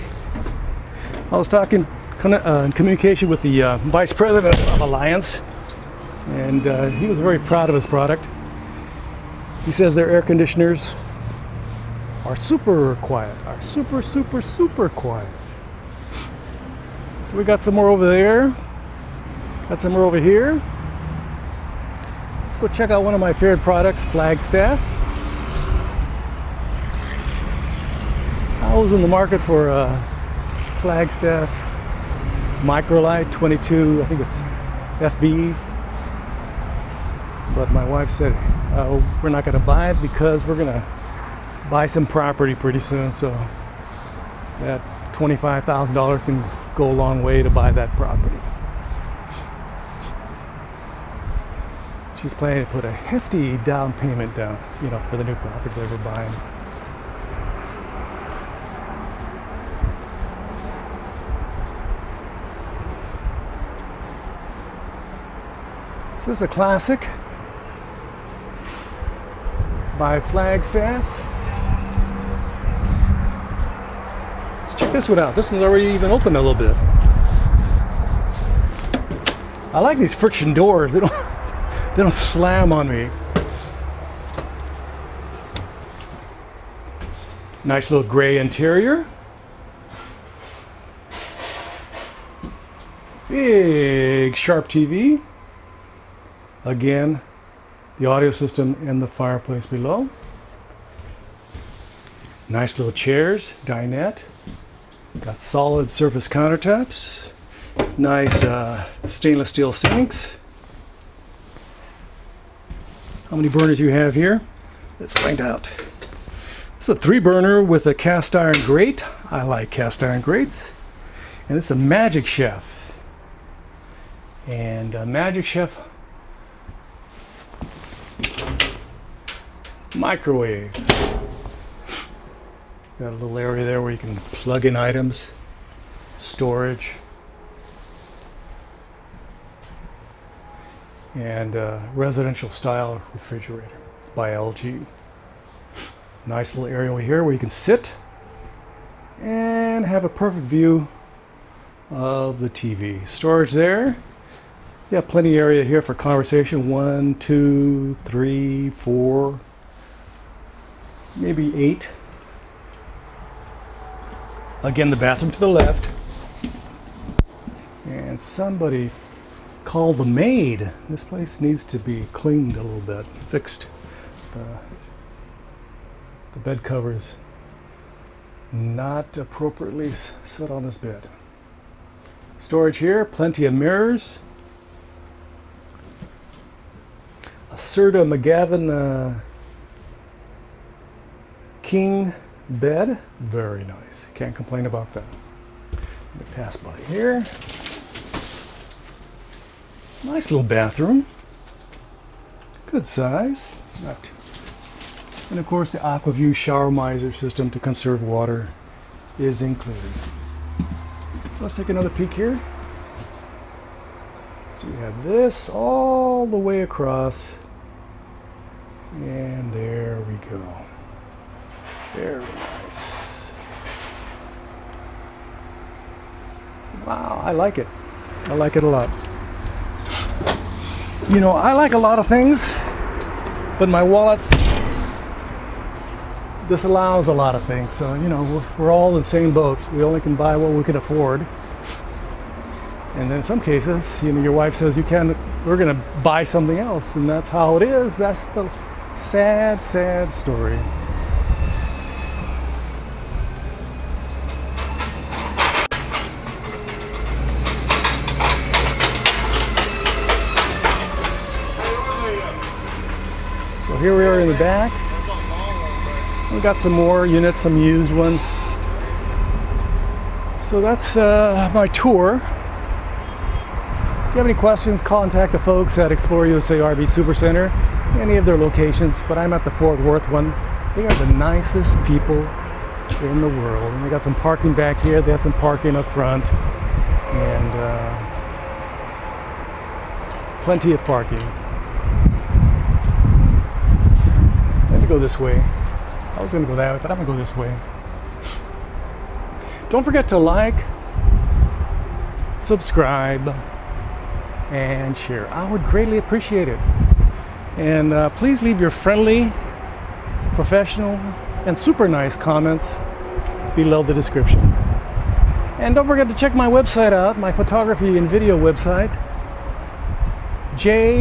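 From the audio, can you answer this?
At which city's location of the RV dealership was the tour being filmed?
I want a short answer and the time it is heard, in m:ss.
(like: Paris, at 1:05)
Fort Worth, at 4:39.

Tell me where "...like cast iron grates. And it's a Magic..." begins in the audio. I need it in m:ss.
1:59.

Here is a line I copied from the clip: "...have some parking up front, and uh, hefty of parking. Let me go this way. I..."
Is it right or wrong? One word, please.
wrong.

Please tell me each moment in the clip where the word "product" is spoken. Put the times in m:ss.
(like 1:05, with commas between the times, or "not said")
0:07, 0:23.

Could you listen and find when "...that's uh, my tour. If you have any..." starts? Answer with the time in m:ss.
4:30.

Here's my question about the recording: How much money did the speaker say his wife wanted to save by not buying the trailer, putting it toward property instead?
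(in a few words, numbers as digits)
$25,000.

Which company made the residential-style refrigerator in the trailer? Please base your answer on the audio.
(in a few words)
LG.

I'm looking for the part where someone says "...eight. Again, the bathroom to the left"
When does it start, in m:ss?
2:41.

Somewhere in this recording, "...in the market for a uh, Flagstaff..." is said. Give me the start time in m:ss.
0:28.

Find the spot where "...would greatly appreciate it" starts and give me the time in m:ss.
5:05.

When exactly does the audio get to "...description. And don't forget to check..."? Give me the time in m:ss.
5:13.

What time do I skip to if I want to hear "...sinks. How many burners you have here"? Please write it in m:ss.
1:49.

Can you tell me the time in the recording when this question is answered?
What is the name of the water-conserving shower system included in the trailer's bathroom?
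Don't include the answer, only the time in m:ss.
3:25.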